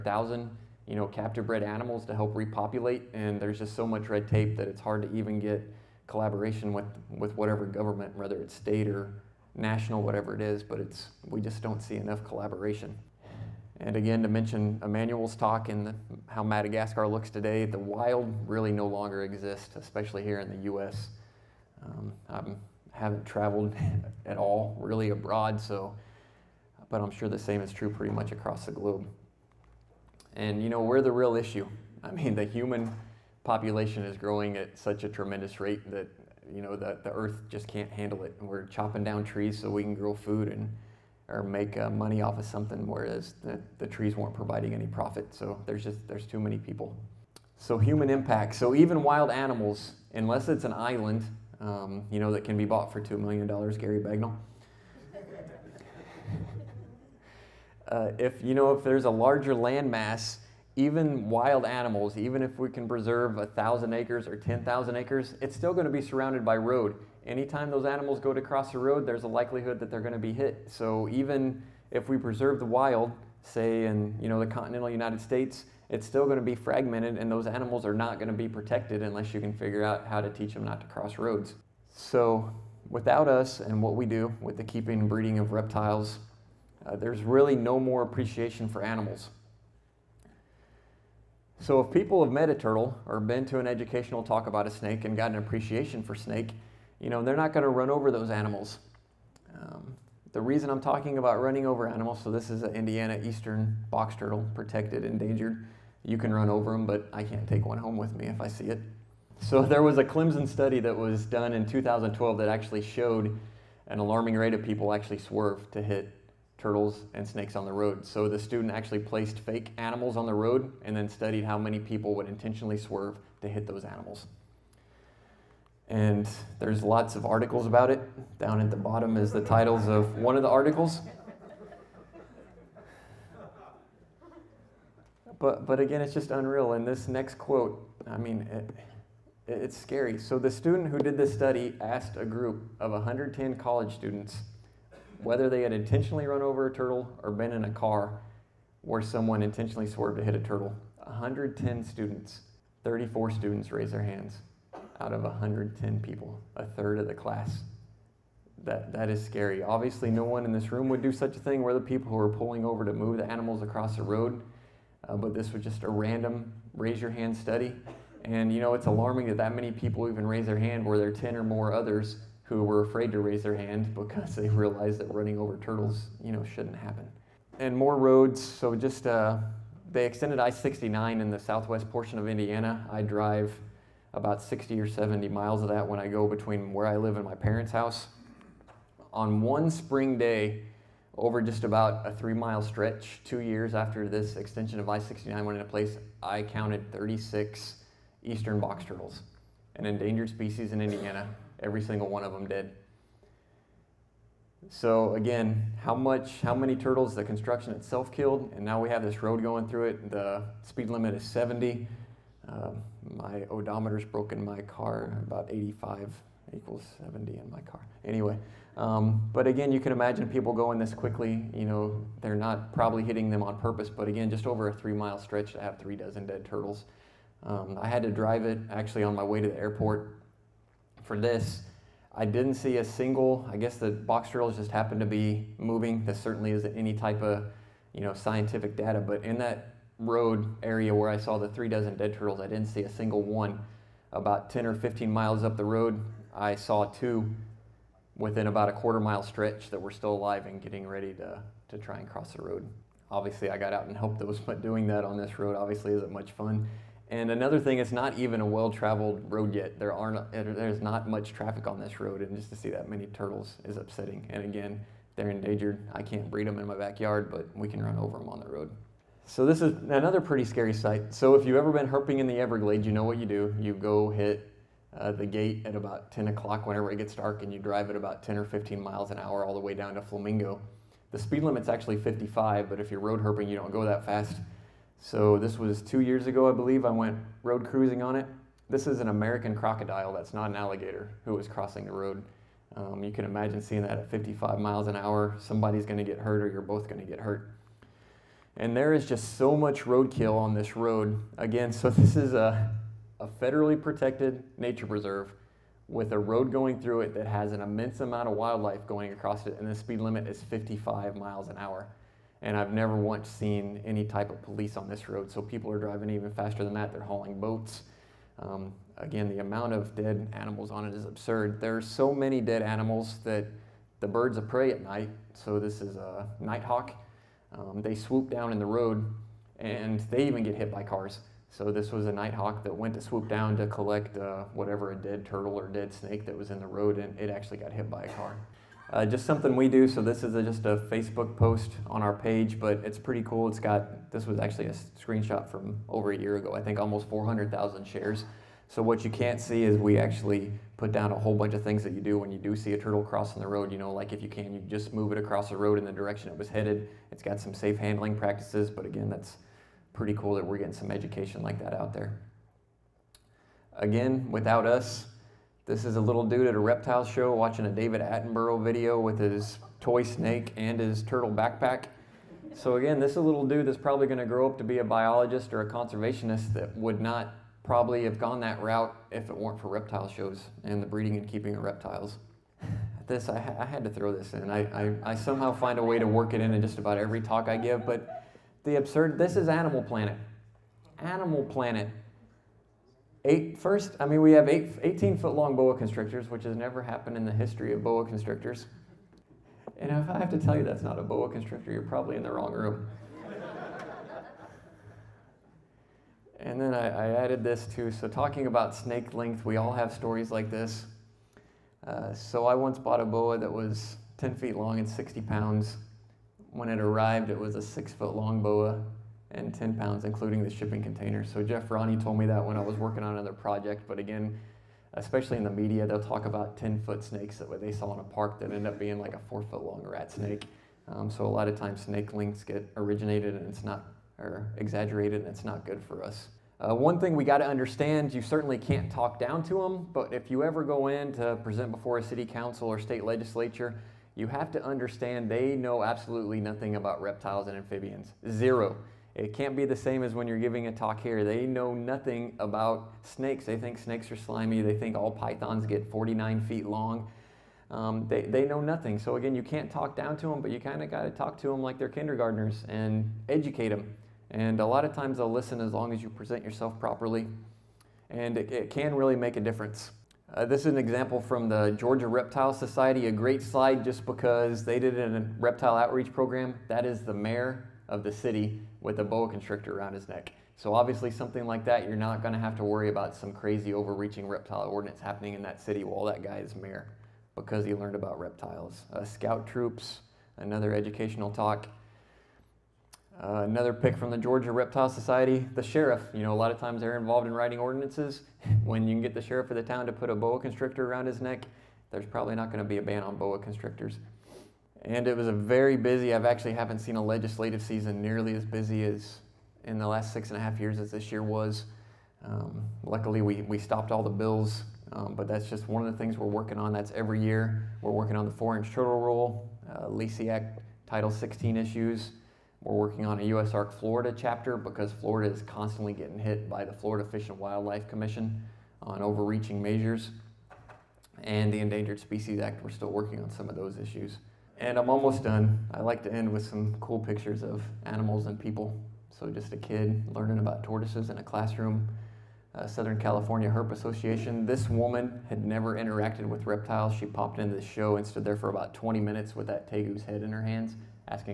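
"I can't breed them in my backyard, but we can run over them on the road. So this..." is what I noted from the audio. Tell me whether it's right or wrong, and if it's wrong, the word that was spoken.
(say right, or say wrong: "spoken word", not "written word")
right.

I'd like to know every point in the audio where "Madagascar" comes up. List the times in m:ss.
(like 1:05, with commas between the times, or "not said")
0:16.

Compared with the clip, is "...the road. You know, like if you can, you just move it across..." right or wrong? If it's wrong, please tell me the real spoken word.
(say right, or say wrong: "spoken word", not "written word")
right.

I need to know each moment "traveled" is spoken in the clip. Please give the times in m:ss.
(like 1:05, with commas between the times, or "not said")
0:23, 4:18.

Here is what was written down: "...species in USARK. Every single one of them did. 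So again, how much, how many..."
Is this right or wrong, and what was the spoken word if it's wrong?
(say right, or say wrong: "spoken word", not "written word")
wrong: "Indiana", not "USARK".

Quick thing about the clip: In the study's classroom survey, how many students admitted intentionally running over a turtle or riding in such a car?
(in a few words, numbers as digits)
34.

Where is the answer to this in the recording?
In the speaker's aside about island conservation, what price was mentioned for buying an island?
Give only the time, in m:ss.
0:52.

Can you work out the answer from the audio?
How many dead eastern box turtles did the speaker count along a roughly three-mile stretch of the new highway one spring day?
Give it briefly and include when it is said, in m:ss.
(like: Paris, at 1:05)
36, at 3:16.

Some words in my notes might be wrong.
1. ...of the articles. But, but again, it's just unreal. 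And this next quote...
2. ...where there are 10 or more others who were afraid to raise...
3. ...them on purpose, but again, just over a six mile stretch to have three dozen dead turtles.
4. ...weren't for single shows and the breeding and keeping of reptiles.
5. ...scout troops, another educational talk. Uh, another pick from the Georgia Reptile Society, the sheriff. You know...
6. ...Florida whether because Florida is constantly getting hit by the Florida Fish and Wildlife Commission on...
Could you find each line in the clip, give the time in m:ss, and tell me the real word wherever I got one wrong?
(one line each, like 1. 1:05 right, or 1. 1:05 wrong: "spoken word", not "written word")
1. 2:10 right
2. 2:50 right
3. 3:43 wrong: "three", not "six"
4. 6:19 wrong: "reptile", not "single"
5. 8:09 right
6. 8:43 wrong: "chapter", not "whether".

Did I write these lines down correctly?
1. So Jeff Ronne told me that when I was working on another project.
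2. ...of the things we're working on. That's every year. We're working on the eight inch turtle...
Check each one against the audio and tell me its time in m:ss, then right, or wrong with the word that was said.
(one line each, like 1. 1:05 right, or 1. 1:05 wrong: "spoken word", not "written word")
1. 7:01 right
2. 8:35 wrong: "four", not "eight".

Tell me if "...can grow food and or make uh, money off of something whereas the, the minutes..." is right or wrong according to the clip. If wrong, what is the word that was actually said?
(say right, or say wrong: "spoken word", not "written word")
wrong: "trees", not "minutes".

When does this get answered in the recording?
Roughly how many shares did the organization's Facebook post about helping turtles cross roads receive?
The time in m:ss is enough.
5:47.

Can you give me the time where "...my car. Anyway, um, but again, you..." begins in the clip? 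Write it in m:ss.
3:37.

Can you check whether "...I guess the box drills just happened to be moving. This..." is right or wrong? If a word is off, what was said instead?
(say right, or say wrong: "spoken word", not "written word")
right.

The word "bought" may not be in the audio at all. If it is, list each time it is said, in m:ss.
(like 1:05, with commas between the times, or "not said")
0:52, 6:52.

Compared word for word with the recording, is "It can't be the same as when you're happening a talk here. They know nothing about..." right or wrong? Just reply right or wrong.
wrong.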